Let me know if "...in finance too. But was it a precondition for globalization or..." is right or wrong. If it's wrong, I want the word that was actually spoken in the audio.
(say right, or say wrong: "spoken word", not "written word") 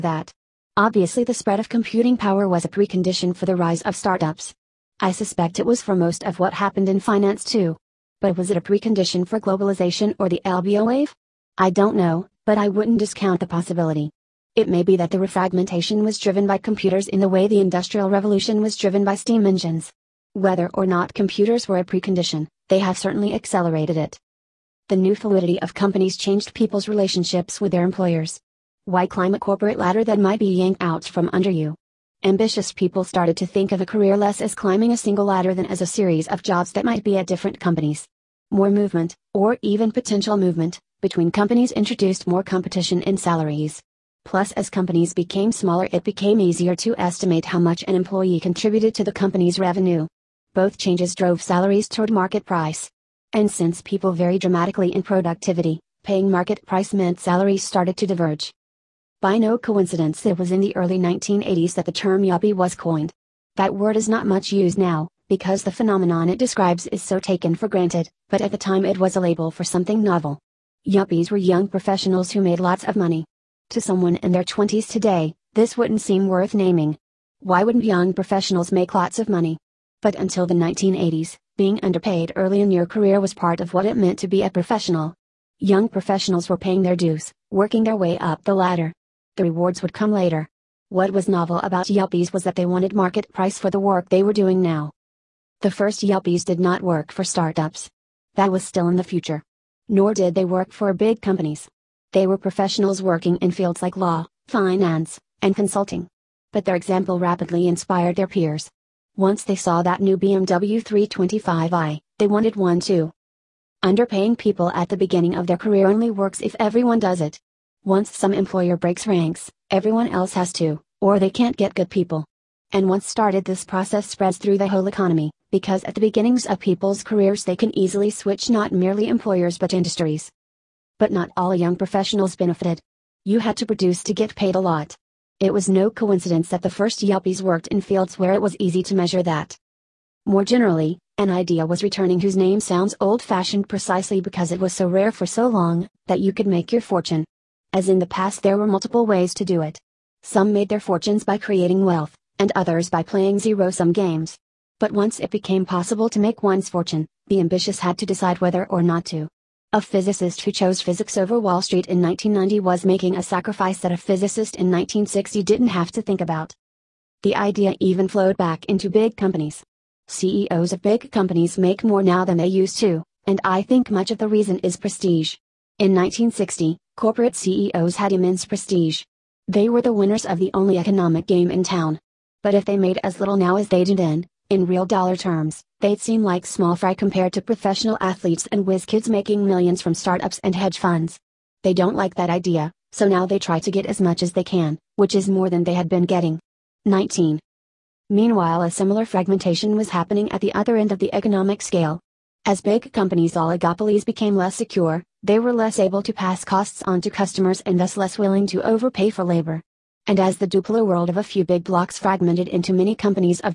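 right.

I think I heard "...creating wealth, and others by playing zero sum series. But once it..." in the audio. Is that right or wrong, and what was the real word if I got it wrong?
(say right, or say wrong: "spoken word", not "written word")
wrong: "games", not "series".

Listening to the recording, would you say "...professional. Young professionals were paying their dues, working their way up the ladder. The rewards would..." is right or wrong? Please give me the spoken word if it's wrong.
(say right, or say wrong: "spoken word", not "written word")
right.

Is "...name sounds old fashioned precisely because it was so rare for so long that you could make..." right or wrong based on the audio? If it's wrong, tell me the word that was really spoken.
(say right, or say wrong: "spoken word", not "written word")
right.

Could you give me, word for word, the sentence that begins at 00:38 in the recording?
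More movement, or even potential movement, between companies introduced more competition in salaries.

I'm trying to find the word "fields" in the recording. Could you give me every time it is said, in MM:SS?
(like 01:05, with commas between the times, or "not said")
01:43, 02:17.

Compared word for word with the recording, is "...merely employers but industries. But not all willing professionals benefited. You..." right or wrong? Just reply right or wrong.
wrong.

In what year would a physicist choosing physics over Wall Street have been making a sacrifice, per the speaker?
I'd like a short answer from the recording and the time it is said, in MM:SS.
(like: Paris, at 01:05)
1990, at 02:42.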